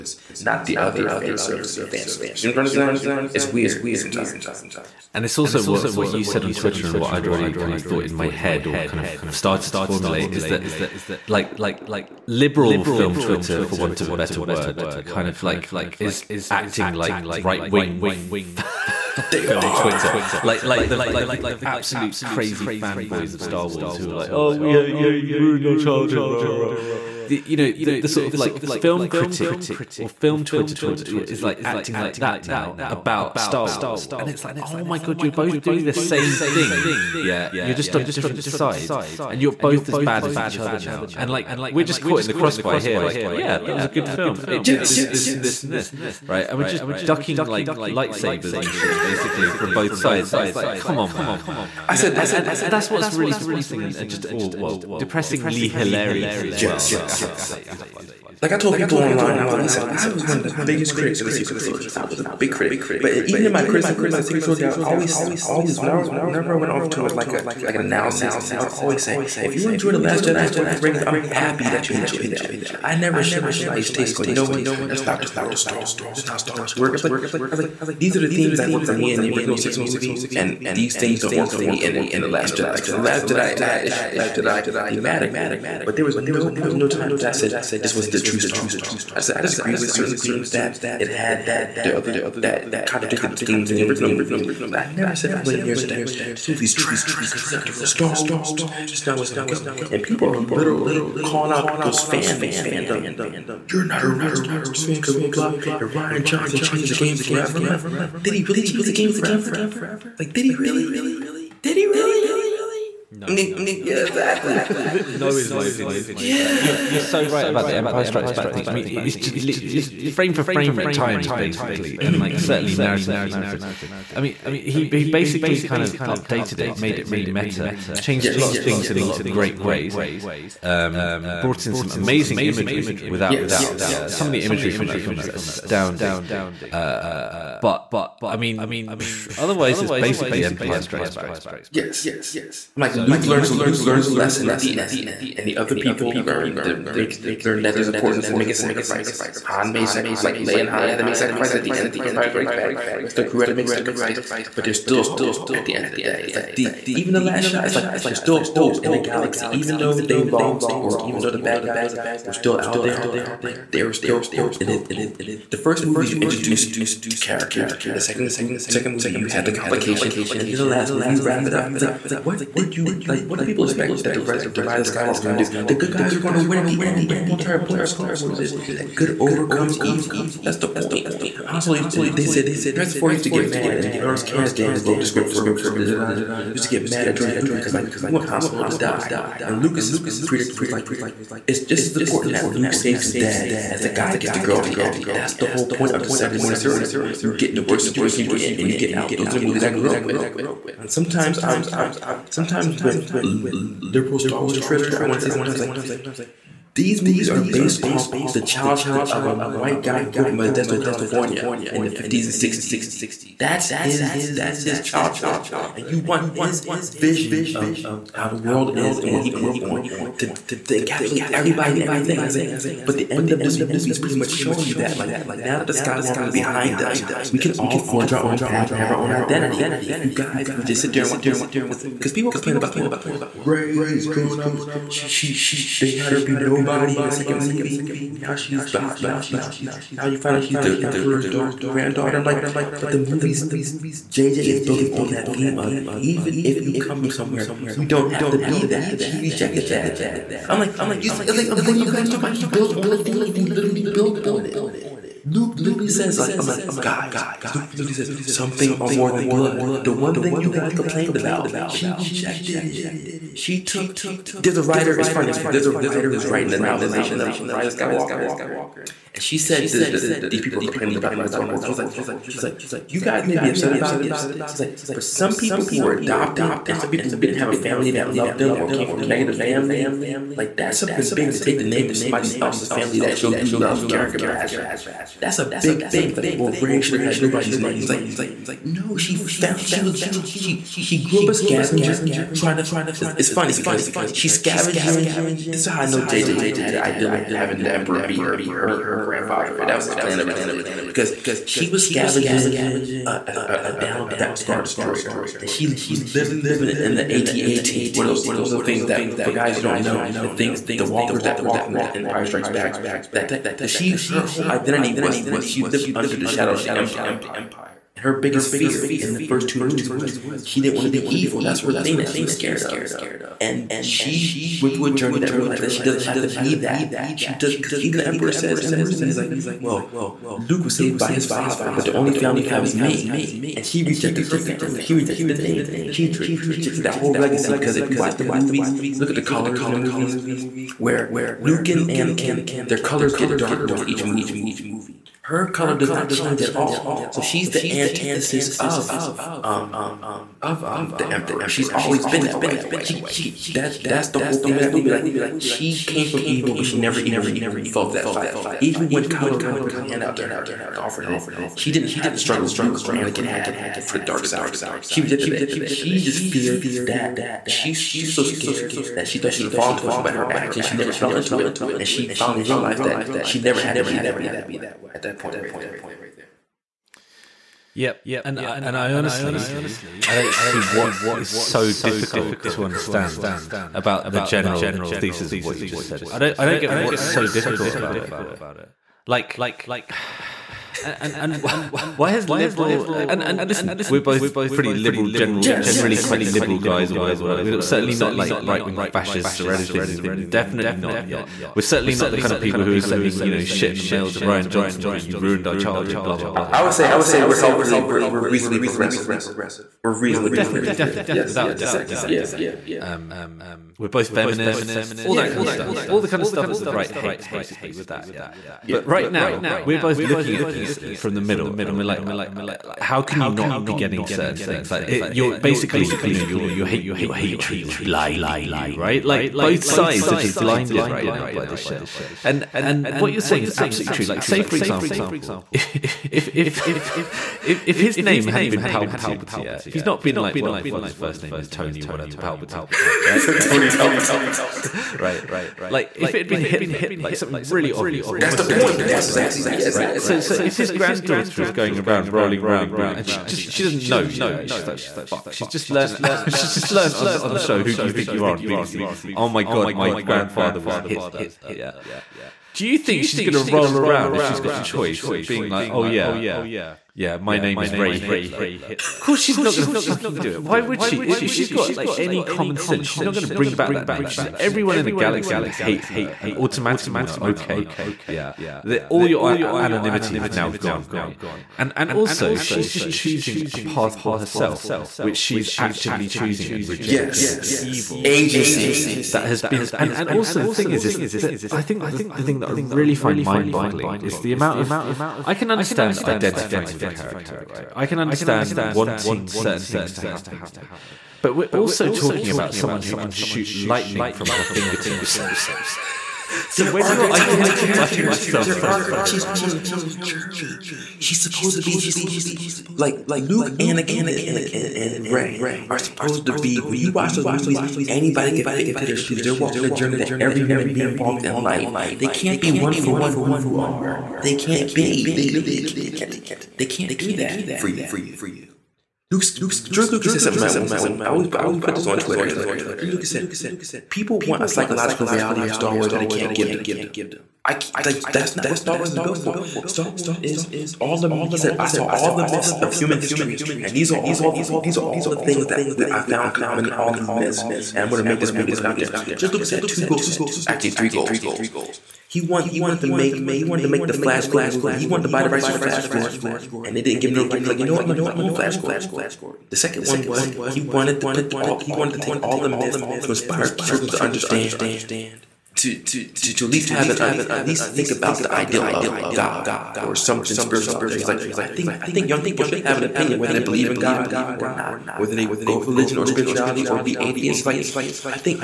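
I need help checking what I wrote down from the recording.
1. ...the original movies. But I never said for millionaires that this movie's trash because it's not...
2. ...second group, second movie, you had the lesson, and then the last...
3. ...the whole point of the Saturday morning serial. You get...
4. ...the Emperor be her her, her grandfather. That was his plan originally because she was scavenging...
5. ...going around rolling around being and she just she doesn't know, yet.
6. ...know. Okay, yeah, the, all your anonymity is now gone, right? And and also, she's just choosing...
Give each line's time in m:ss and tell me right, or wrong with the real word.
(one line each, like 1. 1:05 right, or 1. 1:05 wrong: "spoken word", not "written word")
1. 1:33 right
2. 2:47 wrong: "complication", not "lesson"
3. 3:15 right
4. 4:57 right
5. 7:31 right
6. 7:57 right.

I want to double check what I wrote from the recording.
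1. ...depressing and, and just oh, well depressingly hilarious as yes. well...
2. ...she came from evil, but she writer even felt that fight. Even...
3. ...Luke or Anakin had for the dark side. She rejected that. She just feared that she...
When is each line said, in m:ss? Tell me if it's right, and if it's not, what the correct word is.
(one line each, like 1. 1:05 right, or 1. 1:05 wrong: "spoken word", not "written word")
1. 0:53 right
2. 5:55 wrong: "never", not "writer"
3. 6:02 right.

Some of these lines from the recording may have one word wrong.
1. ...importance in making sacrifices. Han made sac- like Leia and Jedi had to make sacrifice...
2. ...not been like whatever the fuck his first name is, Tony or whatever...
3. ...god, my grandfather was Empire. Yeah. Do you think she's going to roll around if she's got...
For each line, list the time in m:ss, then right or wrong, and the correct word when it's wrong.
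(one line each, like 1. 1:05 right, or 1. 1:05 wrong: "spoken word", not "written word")
1. 2:27 wrong: "Han", not "Jedi"
2. 7:19 right
3. 7:39 wrong: "Hitler", not "Empire".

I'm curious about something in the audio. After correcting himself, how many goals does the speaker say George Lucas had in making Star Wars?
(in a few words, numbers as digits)
3.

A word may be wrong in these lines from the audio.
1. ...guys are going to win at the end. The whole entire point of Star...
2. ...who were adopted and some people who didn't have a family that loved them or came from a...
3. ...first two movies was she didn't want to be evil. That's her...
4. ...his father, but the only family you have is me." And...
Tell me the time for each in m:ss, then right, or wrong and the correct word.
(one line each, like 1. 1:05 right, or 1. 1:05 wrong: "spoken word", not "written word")
1. 2:55 right
2. 4:35 right
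3. 5:19 right
4. 5:31 right.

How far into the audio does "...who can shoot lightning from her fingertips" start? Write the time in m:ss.
8:22.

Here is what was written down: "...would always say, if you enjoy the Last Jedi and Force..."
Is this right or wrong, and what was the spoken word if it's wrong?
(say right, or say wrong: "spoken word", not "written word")
right.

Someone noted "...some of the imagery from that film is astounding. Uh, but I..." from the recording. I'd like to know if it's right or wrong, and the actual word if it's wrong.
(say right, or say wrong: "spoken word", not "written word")
right.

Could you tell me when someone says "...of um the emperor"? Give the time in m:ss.
5:50.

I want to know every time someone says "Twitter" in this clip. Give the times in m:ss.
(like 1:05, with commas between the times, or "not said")
0:06, 0:13, 0:19, 0:30, 3:24, 8:51.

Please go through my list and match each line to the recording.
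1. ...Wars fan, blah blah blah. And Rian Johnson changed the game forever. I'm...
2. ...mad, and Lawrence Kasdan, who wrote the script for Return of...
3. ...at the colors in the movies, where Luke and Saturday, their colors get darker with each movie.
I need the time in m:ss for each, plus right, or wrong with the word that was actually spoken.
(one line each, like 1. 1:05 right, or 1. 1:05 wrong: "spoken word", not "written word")
1. 1:44 right
2. 3:03 right
3. 5:39 wrong: "Anakin", not "Saturday".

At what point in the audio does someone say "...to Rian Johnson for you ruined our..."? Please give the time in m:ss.
6:44.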